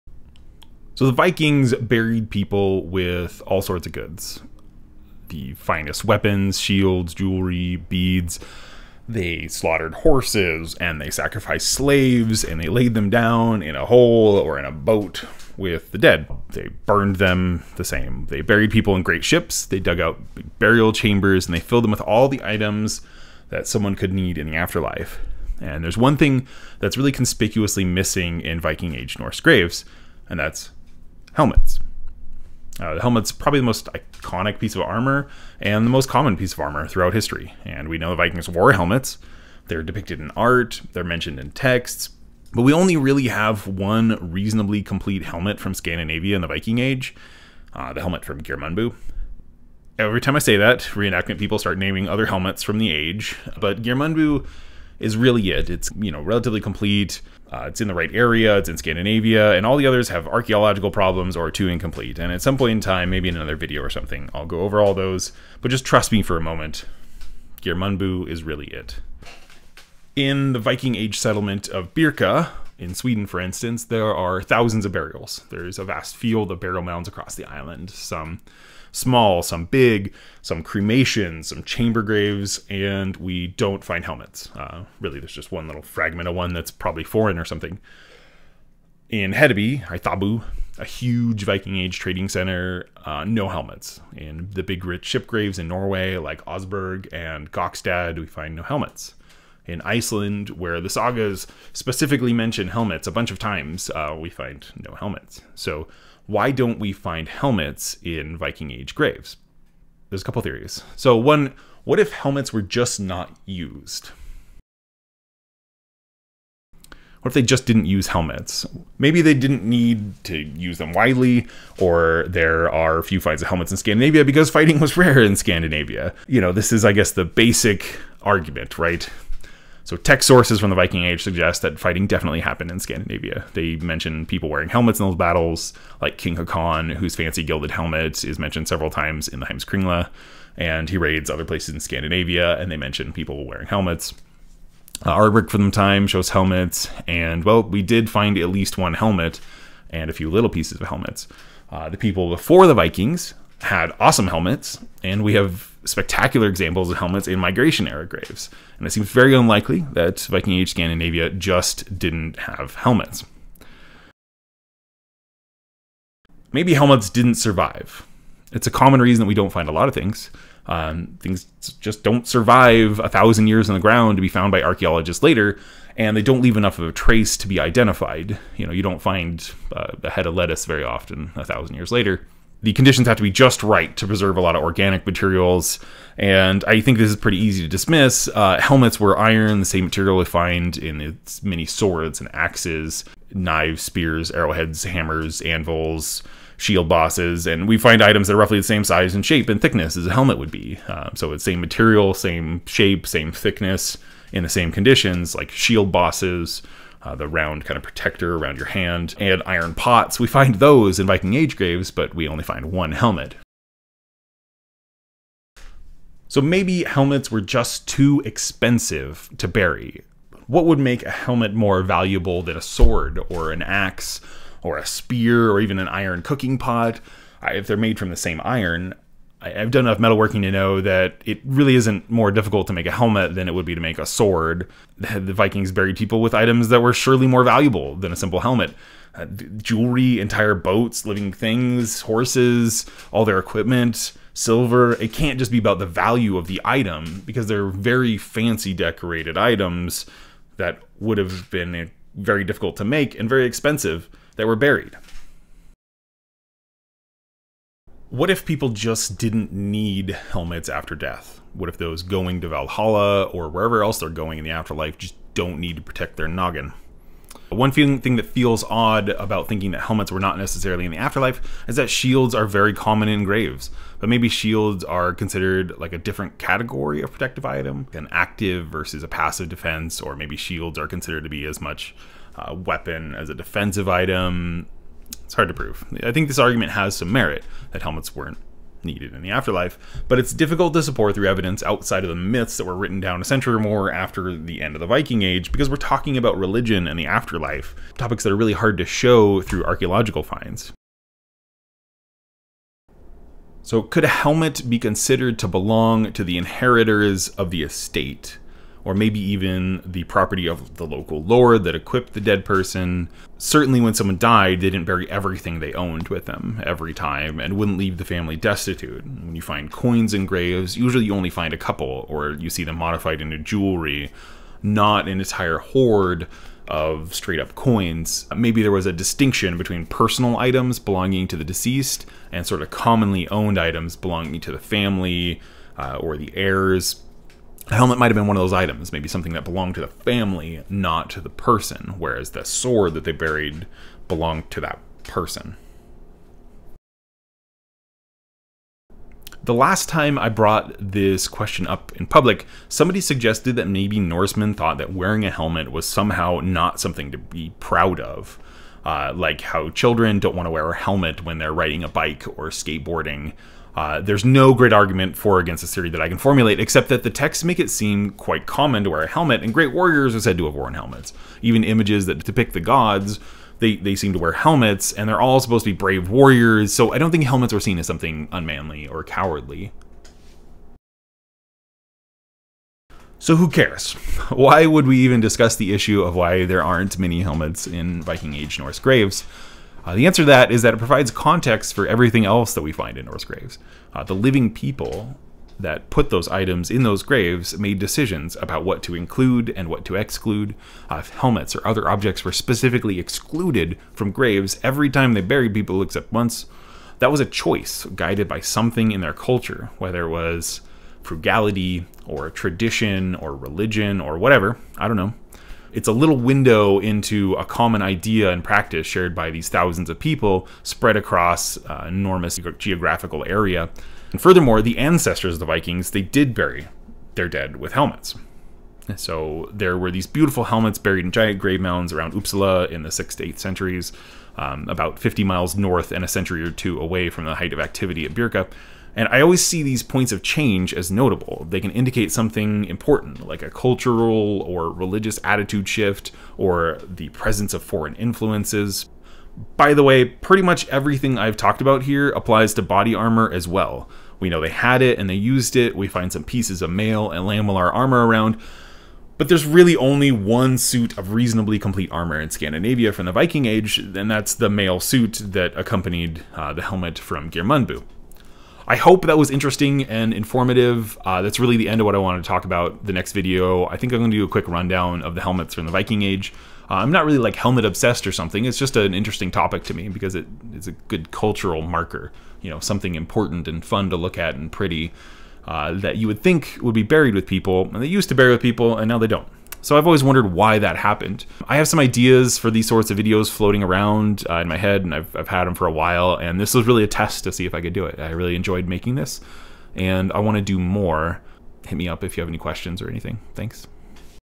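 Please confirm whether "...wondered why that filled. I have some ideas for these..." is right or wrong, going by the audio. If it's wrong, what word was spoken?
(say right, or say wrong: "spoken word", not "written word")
wrong: "happened", not "filled".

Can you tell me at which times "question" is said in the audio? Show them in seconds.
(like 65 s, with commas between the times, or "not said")
351 s, 502 s.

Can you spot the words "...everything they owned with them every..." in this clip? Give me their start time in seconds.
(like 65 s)
315 s.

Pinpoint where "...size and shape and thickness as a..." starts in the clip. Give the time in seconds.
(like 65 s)
198 s.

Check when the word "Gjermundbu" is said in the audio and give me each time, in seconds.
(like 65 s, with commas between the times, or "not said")
48 s, 53 s, 67 s, 467 s.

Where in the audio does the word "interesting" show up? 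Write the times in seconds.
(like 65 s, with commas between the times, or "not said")
469 s, 478 s.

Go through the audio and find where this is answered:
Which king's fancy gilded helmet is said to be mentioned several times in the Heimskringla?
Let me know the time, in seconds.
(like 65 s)
136 s.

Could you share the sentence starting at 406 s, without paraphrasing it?
That was a choice guided by something in their culture, whether it was frugality or tradition or religion or whatever.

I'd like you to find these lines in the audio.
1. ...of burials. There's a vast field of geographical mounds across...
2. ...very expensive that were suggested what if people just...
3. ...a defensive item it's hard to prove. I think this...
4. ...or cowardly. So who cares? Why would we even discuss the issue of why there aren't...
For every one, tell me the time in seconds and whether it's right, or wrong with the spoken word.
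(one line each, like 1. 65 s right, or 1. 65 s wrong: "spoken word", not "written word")
1. 74 s wrong: "burial", not "geographical"
2. 253 s wrong: "buried", not "suggested"
3. 283 s right
4. 378 s right.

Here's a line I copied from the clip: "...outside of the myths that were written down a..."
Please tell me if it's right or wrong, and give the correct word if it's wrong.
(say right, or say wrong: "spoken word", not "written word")
right.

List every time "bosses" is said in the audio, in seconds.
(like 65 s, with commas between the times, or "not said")
196 s, 205 s.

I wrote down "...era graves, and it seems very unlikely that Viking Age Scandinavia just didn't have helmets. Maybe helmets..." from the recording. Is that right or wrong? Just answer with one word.
right.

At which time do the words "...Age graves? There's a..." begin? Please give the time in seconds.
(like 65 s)
108 s.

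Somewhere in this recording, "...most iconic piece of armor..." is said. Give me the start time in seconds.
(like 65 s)
33 s.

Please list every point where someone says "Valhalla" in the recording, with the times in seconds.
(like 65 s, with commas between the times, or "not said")
262 s.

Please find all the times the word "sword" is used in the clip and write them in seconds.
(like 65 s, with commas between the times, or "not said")
191 s, 222 s, 234 s, 342 s.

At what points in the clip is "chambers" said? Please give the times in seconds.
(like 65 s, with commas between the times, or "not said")
20 s, 81 s.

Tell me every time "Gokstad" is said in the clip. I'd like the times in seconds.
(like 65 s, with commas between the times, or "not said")
97 s.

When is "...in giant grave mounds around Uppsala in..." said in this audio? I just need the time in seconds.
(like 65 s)
431 s.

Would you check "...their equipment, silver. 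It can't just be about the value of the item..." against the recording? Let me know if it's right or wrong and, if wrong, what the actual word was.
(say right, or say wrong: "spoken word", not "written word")
right.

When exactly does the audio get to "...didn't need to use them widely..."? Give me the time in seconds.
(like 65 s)
119 s.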